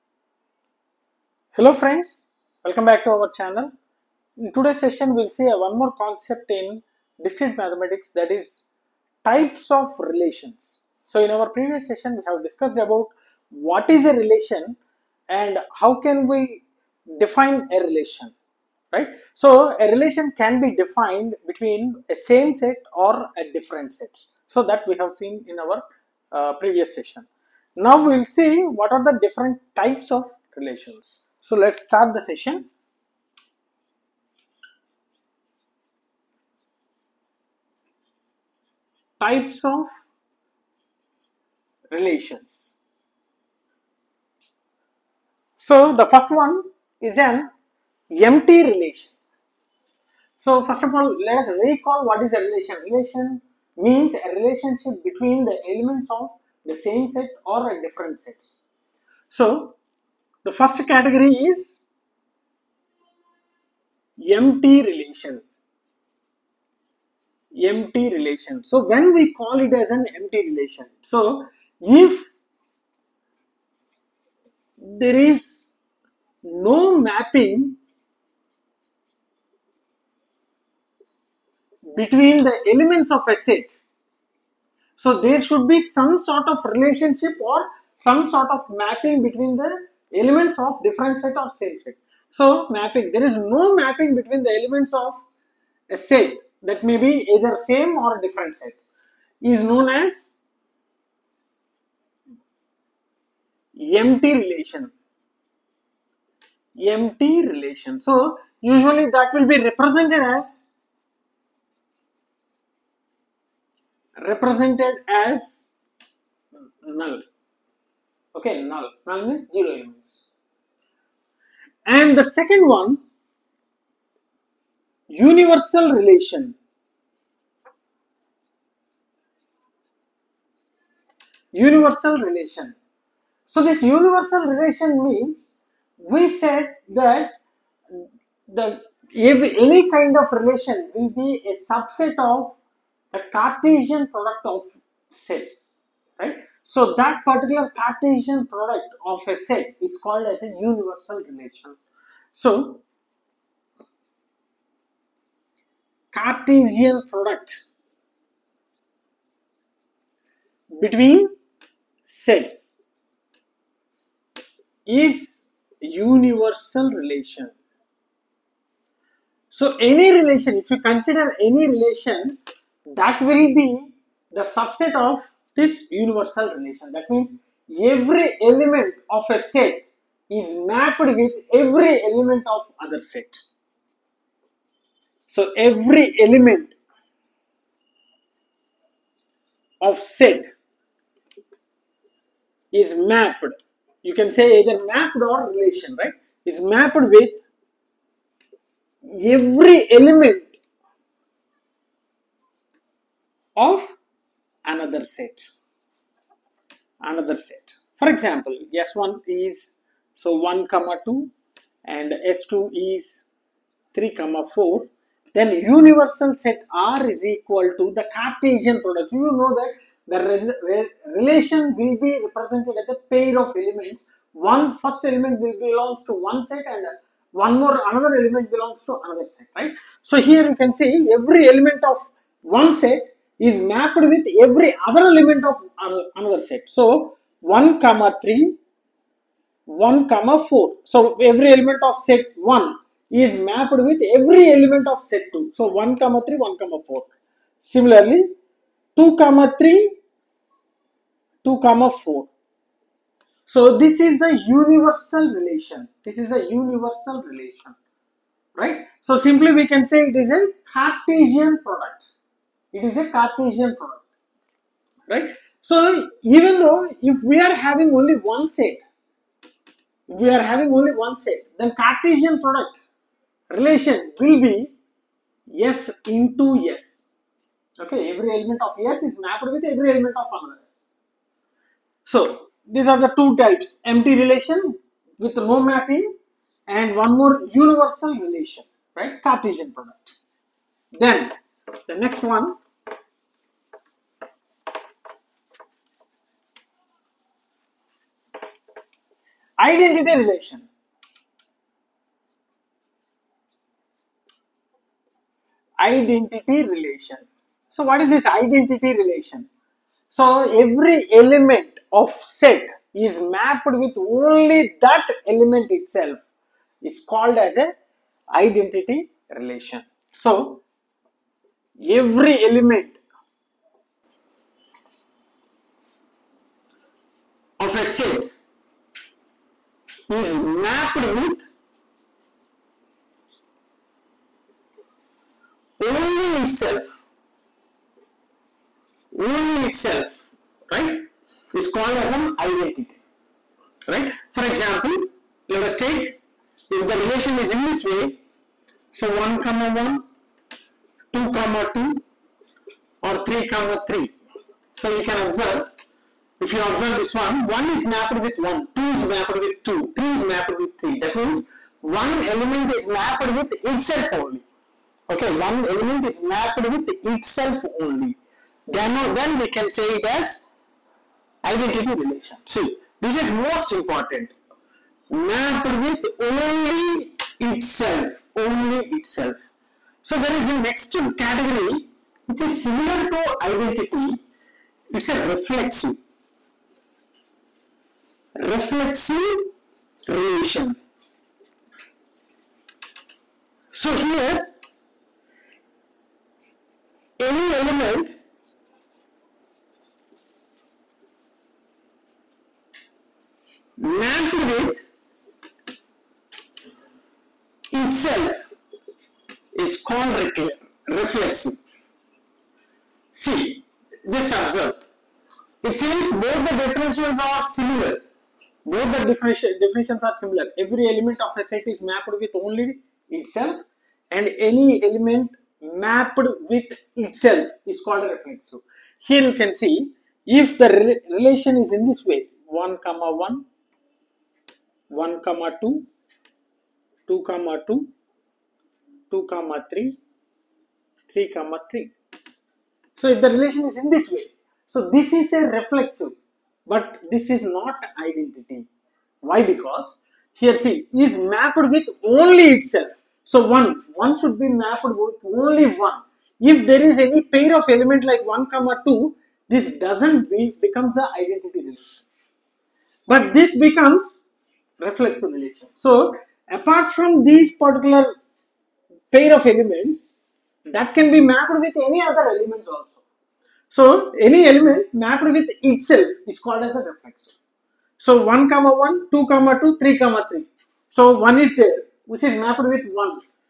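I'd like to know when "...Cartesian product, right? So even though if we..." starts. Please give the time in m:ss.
4:23.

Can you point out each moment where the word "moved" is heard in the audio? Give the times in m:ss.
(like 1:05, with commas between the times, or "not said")
not said.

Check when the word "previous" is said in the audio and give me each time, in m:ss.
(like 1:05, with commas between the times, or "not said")
0:11, 0:26.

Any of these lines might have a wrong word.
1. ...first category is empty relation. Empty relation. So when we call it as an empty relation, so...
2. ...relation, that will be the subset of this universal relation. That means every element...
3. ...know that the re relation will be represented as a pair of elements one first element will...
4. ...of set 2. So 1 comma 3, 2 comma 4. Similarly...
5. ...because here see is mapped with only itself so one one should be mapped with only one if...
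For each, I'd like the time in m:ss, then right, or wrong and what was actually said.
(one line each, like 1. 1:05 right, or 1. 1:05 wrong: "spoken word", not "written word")
1. 1:00 right
2. 2:51 right
3. 3:39 right
4. 4:04 wrong: "1", not "2"
5. 7:29 right.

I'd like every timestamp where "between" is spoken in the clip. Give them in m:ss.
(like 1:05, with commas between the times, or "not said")
0:21, 0:55, 1:21, 1:29, 1:34, 2:40.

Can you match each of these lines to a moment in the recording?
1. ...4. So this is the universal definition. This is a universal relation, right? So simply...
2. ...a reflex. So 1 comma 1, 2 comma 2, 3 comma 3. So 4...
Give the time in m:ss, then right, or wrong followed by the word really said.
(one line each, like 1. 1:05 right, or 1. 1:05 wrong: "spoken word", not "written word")
1. 4:11 wrong: "relation", not "definition"
2. 7:56 wrong: "1", not "4".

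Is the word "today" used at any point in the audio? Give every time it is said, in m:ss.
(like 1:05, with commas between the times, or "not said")
0:04.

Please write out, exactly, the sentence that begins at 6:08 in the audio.
Then, then we can say it as identity relation.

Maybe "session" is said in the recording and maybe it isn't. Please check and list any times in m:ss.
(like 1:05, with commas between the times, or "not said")
0:04, 0:11, 0:26, 0:32.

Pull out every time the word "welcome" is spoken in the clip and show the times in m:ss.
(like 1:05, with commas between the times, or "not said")
0:02.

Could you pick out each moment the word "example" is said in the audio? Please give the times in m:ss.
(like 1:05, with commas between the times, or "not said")
3:28, 5:44.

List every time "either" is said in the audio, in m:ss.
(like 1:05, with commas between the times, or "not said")
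1:37, 3:14.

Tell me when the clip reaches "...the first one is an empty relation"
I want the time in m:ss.
0:45.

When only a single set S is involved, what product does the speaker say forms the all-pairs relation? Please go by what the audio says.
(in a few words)
S into S.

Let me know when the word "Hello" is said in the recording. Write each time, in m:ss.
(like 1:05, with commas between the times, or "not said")
0:01.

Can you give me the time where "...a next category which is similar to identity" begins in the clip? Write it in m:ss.
6:20.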